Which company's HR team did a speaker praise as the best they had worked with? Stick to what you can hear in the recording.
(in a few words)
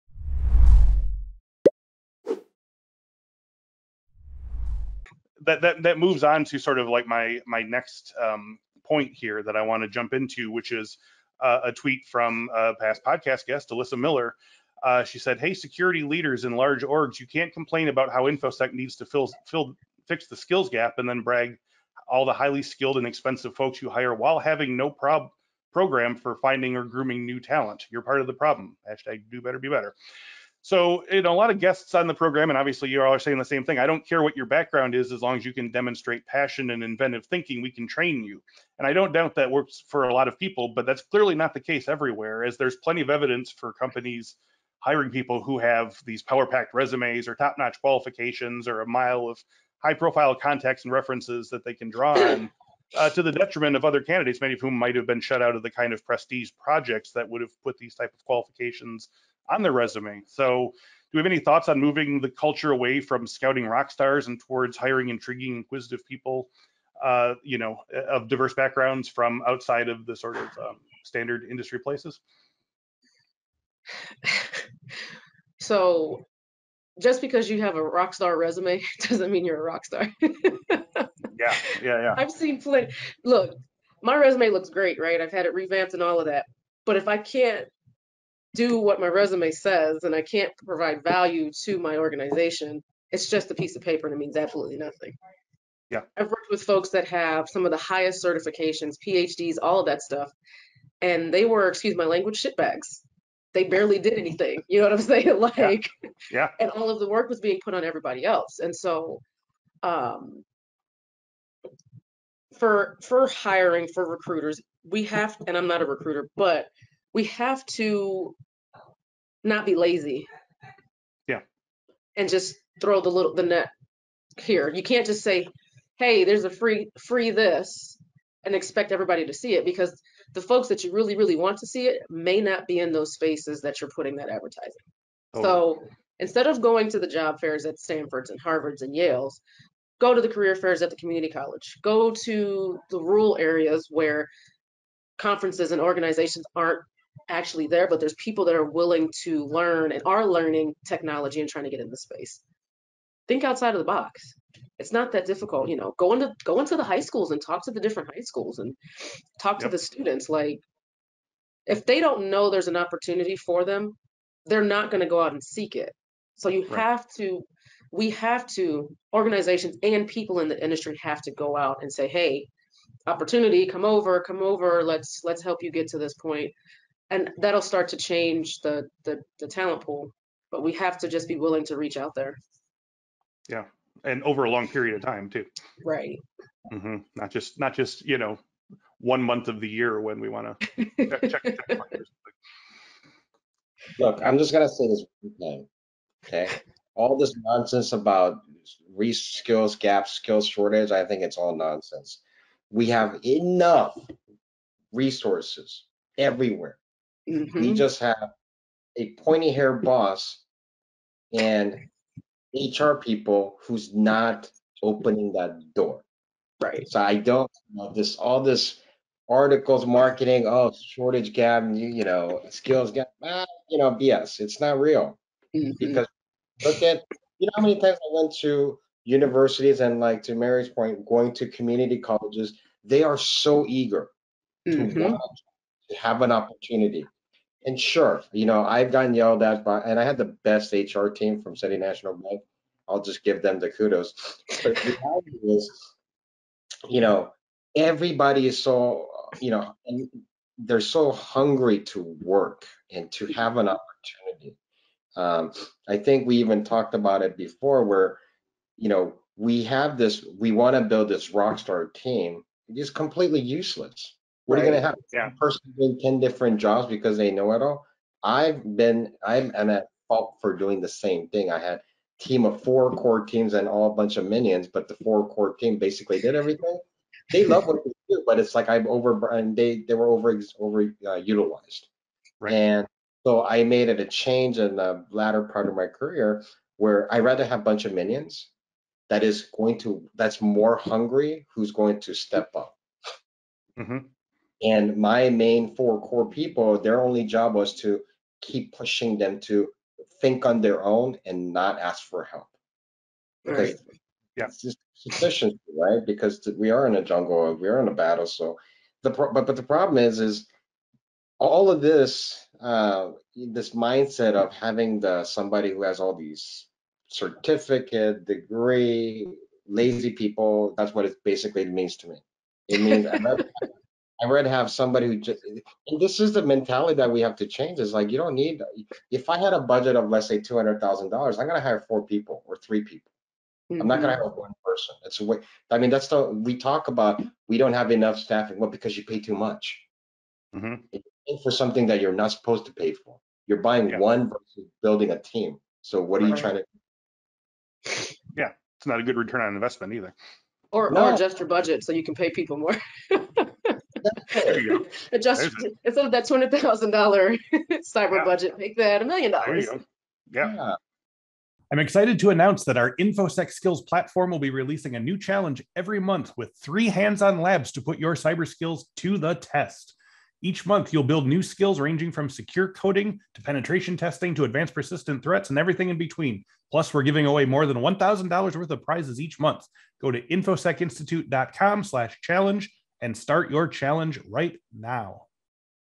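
City National Bank.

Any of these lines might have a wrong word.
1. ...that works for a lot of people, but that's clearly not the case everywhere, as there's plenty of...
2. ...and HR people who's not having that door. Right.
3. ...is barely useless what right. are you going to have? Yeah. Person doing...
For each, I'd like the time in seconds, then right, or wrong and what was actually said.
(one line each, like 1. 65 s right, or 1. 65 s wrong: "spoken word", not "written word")
1. 39 s right
2. 211 s wrong: "opening", not "having"
3. 262 s wrong: "completely", not "barely".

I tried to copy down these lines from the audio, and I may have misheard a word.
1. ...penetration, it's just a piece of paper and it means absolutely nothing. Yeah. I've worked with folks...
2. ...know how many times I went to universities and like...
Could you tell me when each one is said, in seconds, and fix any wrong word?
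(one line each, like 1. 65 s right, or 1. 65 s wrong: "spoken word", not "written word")
1. 91 s wrong: "organization", not "penetration"
2. 227 s right.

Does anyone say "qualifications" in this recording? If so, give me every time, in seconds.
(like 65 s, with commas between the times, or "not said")
47 s, 58 s.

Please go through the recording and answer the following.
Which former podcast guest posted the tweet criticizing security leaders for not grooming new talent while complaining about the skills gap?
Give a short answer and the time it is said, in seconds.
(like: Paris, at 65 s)
Alyssa Miller, at 13 s.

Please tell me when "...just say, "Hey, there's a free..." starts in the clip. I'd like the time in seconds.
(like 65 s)
125 s.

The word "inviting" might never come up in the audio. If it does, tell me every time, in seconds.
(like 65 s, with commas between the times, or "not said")
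not said.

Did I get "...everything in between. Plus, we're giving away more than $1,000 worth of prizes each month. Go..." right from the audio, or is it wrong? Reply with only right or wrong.
right.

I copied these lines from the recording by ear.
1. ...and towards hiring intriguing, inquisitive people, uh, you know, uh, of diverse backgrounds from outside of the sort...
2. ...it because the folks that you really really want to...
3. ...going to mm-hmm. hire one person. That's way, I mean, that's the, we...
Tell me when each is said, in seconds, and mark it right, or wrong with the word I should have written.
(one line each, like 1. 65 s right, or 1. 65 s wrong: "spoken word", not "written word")
1. 64 s right
2. 129 s right
3. 334 s right.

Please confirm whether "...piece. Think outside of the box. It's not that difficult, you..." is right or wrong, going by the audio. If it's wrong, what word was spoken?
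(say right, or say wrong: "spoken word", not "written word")
wrong: "space", not "piece".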